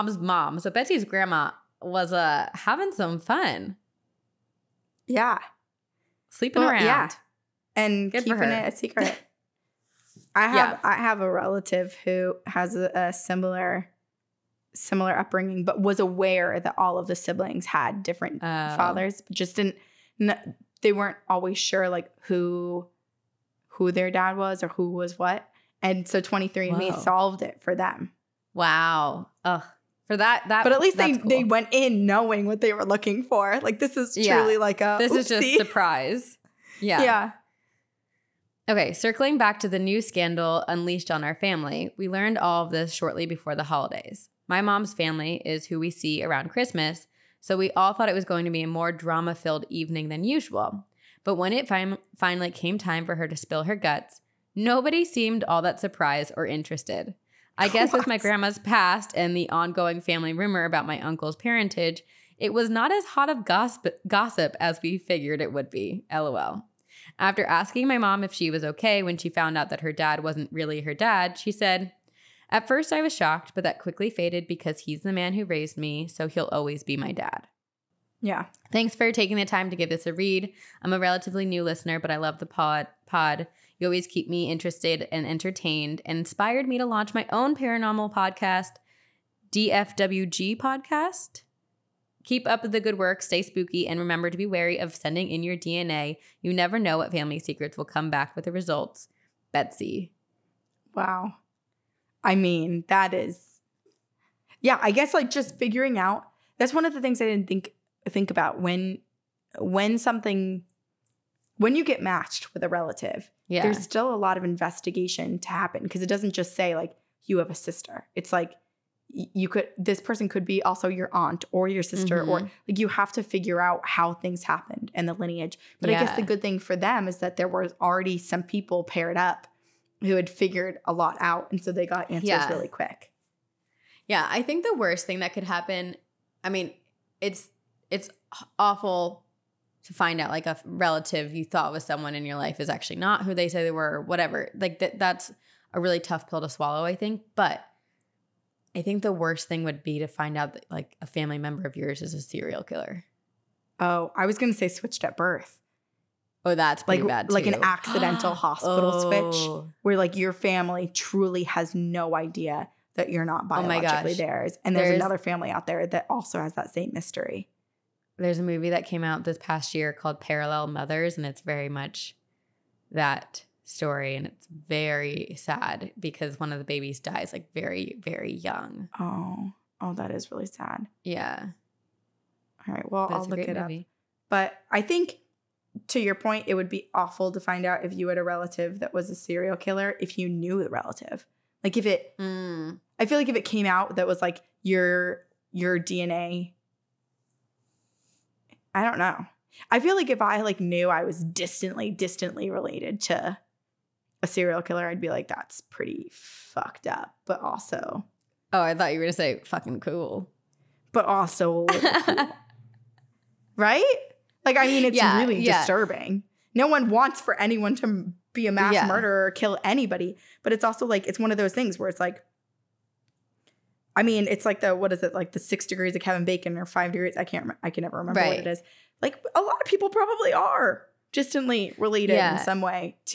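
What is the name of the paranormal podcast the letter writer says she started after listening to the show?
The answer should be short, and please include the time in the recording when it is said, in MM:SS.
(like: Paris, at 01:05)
DFWG Podcast, at 01:29.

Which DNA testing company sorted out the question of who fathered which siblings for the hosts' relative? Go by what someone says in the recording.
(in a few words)
23andMe.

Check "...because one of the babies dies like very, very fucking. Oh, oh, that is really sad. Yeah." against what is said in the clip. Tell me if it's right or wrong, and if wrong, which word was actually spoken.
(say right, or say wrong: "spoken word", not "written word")
wrong: "young", not "fucking".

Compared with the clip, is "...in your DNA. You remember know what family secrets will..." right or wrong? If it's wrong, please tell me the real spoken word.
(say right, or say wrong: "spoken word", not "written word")
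wrong: "never", not "remember".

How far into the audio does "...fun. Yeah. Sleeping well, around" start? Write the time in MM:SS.
00:03.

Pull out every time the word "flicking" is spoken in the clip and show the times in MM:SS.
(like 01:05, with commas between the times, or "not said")
not said.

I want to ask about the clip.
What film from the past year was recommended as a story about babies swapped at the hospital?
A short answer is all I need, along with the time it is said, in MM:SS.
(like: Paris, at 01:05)
Parallel Mothers, at 02:50.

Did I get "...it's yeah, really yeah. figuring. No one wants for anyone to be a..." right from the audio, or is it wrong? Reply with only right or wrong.
wrong.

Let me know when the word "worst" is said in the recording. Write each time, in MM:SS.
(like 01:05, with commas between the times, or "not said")
02:14, 02:29.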